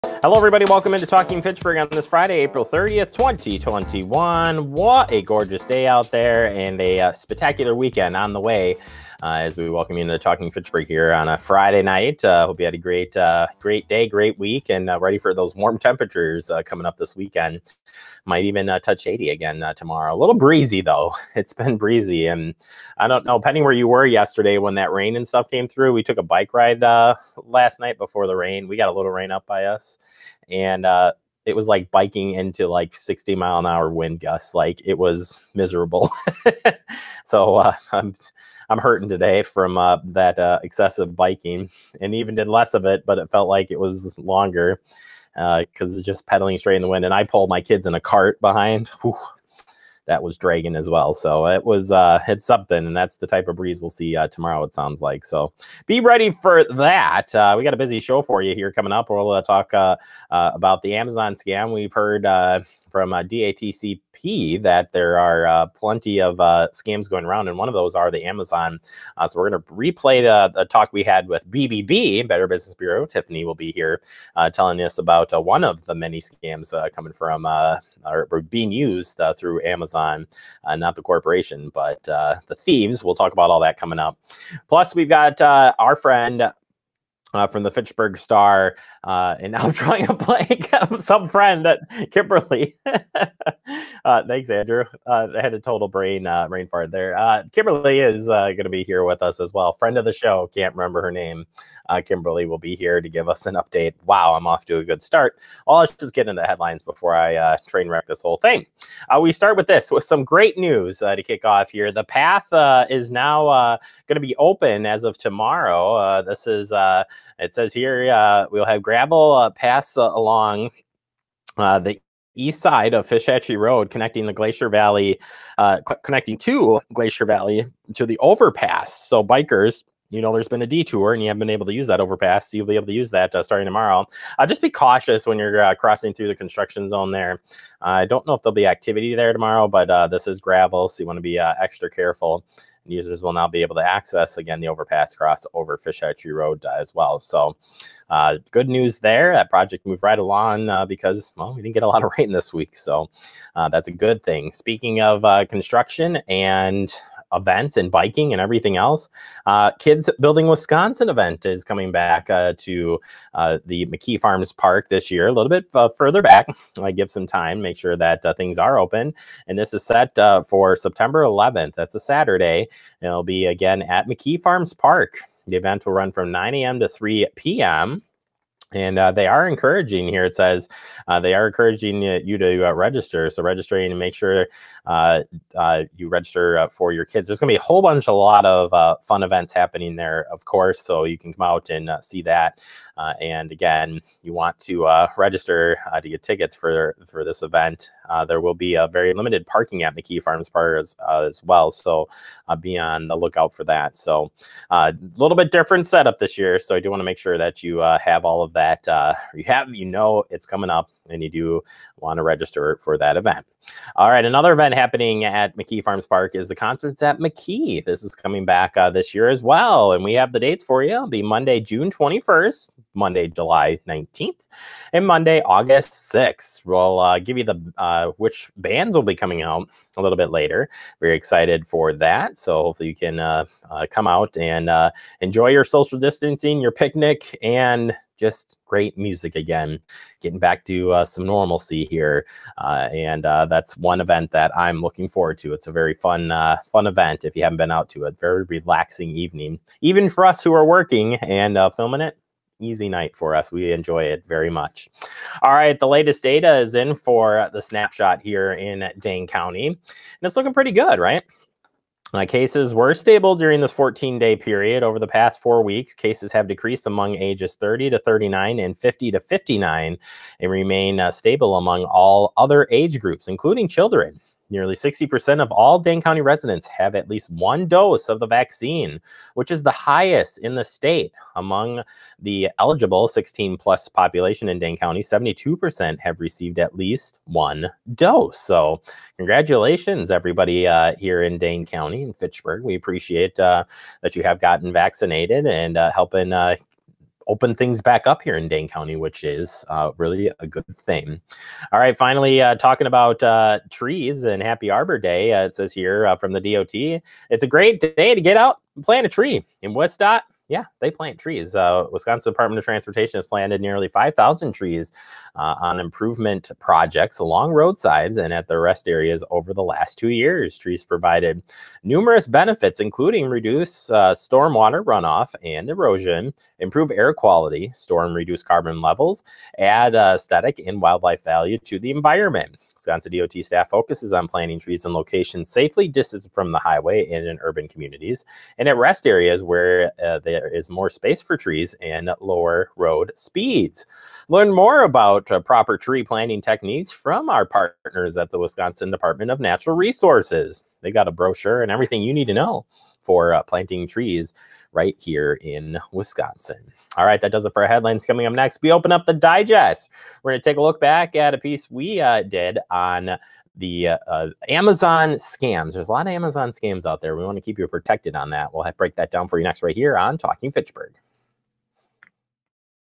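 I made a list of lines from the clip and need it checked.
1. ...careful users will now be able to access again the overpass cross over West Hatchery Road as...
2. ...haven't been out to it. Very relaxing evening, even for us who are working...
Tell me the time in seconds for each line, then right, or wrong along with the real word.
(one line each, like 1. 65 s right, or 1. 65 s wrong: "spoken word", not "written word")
1. 141 s wrong: "Fish", not "West"
2. 247 s right.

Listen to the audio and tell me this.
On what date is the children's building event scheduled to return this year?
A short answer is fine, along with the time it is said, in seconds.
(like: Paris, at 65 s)
September 11th, at 170 s.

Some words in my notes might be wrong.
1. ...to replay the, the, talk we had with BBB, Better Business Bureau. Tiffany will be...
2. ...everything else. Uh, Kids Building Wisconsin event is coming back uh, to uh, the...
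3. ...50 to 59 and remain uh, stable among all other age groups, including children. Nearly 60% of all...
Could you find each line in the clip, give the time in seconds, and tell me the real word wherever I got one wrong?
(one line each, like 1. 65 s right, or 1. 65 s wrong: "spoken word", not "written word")
1. 69 s right
2. 158 s right
3. 268 s right.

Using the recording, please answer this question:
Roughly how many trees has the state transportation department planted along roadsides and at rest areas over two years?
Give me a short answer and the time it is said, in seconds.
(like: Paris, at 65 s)
5,000, at 313 s.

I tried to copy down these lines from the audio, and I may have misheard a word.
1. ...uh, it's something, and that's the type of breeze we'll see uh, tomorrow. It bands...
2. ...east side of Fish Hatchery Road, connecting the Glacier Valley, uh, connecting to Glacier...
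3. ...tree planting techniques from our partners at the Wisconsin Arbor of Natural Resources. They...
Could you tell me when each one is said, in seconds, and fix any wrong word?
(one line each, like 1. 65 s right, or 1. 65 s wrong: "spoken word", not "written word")
1. 51 s wrong: "sounds", not "bands"
2. 122 s right
3. 345 s wrong: "Department", not "Arbor".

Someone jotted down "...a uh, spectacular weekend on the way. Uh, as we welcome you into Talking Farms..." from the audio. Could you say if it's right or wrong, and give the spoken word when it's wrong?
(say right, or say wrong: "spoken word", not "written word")
wrong: "Fitchburg", not "Farms".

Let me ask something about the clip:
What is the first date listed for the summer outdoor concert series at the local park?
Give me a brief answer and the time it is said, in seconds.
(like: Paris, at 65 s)
June 21st, at 221 s.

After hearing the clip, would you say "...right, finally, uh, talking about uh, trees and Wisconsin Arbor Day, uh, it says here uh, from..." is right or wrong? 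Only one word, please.
wrong.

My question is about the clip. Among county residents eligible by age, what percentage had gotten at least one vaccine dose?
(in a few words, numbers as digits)
72%.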